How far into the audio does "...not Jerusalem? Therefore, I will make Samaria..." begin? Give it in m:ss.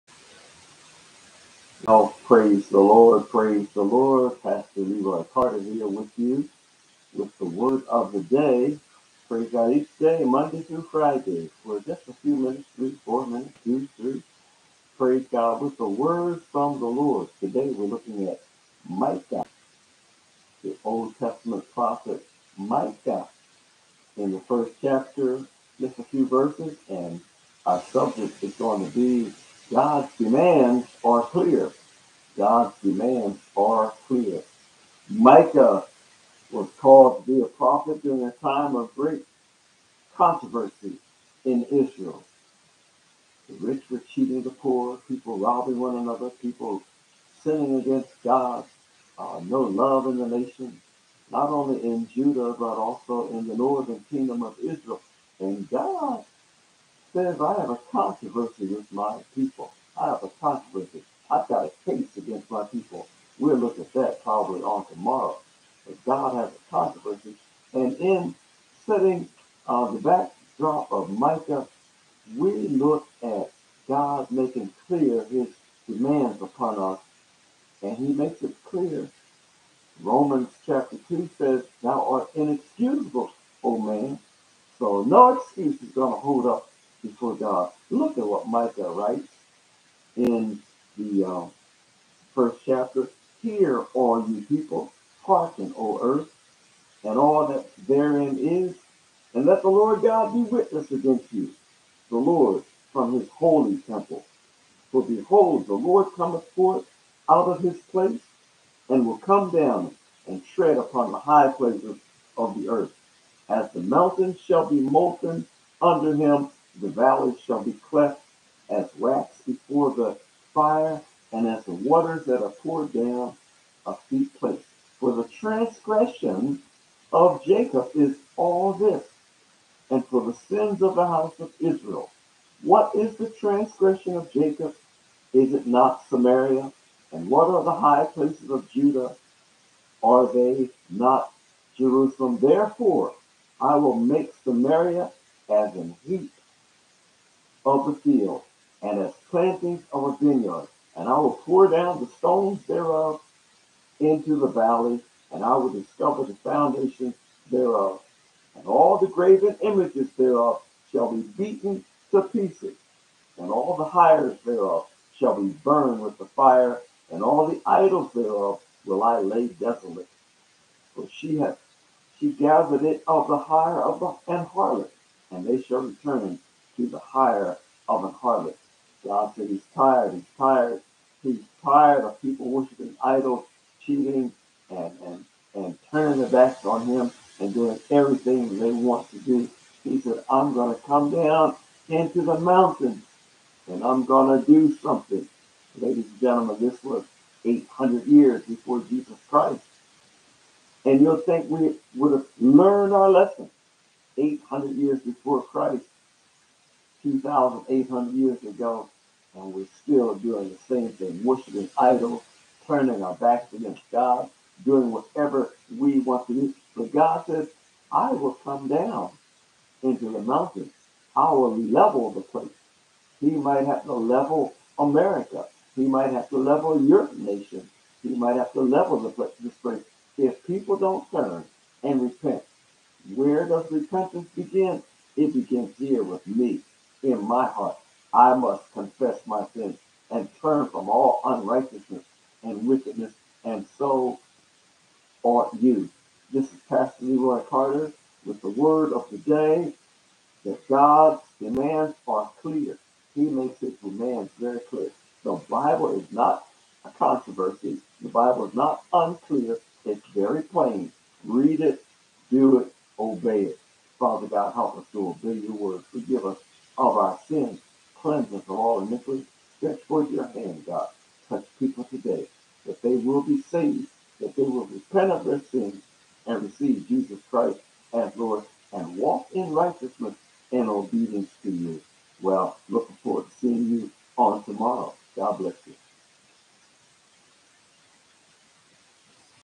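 2:20.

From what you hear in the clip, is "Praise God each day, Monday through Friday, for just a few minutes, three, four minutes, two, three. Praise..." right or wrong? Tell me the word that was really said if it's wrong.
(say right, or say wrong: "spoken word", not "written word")
right.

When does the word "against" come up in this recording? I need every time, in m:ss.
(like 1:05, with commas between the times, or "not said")
0:47, 1:02, 1:40, 3:33.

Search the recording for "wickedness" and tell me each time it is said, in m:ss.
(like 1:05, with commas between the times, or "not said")
4:02.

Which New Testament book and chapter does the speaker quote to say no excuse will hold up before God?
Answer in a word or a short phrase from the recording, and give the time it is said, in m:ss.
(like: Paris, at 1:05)
Romans chapter 2, at 1:20.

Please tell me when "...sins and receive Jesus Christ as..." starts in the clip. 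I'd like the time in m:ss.
4:35.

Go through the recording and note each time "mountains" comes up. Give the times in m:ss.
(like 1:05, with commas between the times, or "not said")
1:53, 3:12, 3:40.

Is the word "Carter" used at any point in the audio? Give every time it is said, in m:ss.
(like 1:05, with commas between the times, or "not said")
0:05, 4:07.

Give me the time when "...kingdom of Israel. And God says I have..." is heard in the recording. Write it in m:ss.
0:54.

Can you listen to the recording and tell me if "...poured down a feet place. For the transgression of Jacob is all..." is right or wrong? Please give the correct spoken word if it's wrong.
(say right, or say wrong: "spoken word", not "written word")
right.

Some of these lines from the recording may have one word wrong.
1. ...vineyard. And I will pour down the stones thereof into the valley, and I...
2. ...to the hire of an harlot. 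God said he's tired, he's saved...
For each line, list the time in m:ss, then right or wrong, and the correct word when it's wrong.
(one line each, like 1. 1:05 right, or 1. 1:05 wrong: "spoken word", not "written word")
1. 2:30 right
2. 2:56 wrong: "tired", not "saved".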